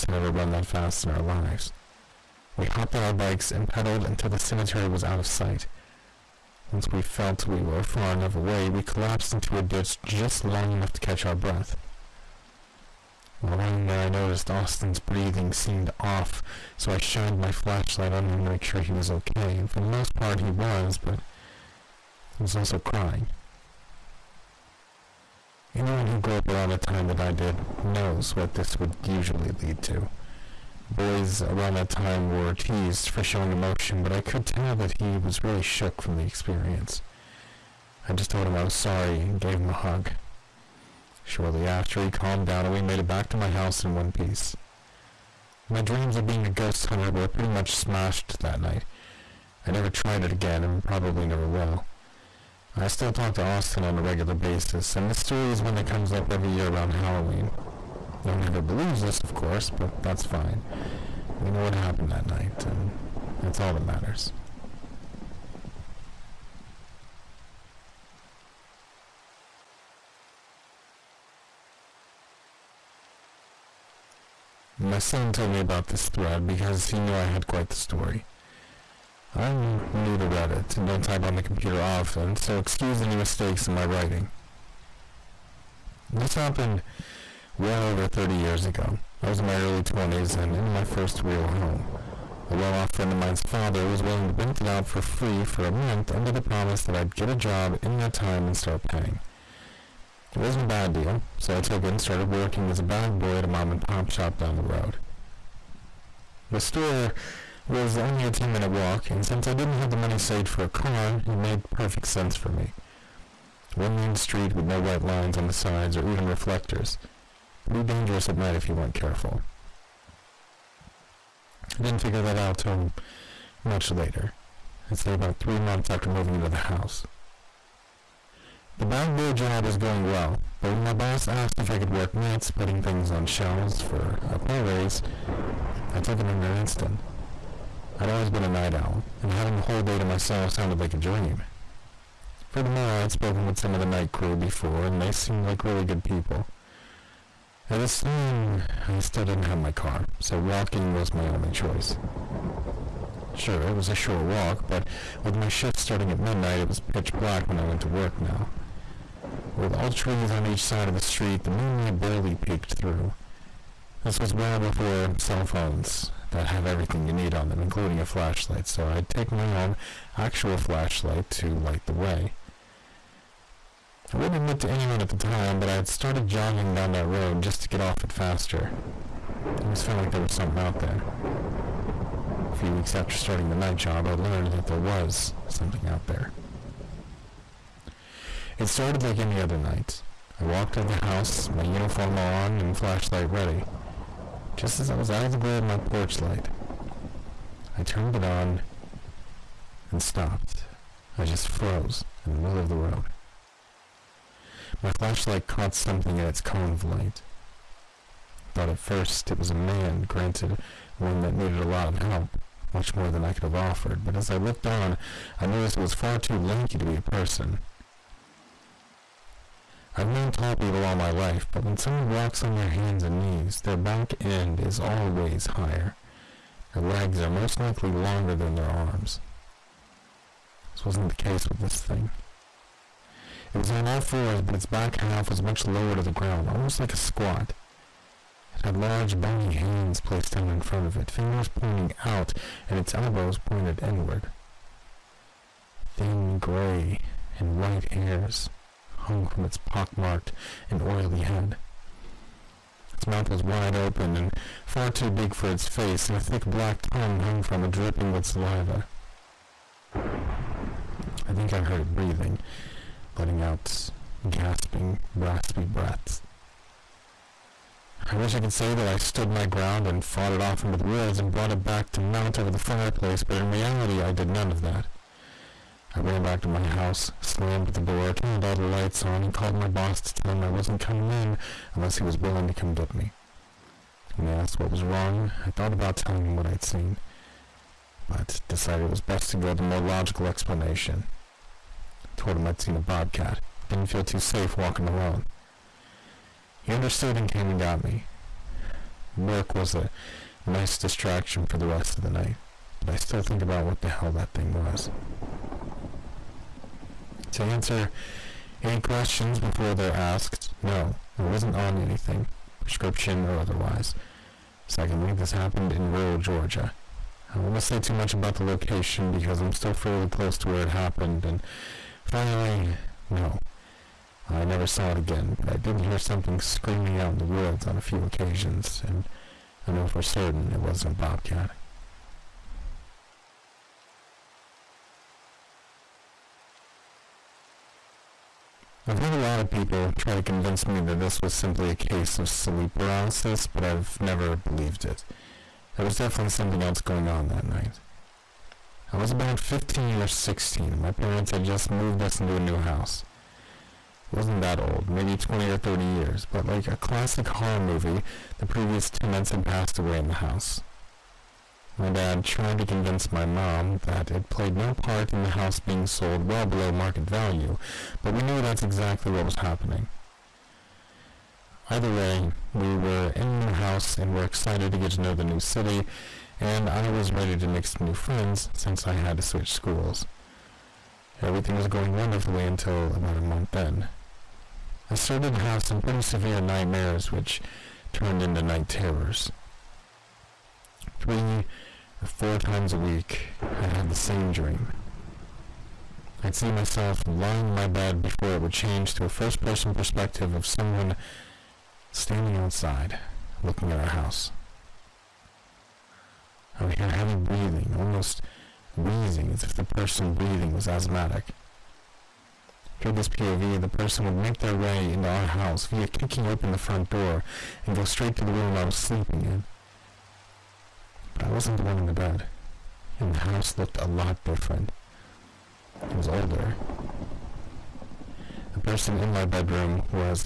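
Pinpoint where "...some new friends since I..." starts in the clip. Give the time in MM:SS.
06:17.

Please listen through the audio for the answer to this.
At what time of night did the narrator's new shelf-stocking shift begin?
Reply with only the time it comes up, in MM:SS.
02:36.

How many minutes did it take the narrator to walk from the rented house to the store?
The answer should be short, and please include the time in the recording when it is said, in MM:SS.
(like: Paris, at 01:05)
10, at 01:48.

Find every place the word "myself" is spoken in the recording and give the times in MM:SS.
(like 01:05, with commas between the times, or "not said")
02:20, 06:36.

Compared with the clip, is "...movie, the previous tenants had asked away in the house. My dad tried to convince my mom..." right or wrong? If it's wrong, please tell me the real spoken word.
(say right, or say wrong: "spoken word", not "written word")
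wrong: "passed", not "asked".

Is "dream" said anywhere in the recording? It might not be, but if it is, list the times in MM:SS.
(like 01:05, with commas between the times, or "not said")
00:45, 02:20, 06:34.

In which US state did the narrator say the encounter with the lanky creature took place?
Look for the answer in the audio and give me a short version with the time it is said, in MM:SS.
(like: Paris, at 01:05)
Georgia, at 05:16.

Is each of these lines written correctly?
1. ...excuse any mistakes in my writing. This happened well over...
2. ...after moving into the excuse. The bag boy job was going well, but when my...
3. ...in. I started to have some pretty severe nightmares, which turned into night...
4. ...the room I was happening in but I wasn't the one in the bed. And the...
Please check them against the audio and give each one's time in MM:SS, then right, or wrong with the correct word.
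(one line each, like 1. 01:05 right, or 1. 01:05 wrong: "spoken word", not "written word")
1. 01:22 right
2. 02:05 wrong: "house", not "excuse"
3. 06:23 right
4. 06:58 wrong: "sleeping", not "happening".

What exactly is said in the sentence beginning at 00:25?
Anyone who grew up around the time that I did knows what this would usually lead to.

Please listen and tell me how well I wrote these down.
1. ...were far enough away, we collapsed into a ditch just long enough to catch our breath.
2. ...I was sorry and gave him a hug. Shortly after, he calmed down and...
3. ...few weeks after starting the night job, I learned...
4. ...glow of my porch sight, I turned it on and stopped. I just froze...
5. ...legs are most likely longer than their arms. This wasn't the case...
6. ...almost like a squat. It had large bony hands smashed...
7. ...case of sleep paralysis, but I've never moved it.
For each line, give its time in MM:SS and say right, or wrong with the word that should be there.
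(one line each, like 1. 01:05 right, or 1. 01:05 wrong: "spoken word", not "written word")
1. 00:07 right
2. 00:38 right
3. 03:02 right
4. 03:15 wrong: "light", not "sight"
5. 03:46 right
6. 03:56 wrong: "placed", not "smashed"
7. 05:41 wrong: "believed", not "moved".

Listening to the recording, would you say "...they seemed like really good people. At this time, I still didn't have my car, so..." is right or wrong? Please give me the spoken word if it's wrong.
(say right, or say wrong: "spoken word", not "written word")
right.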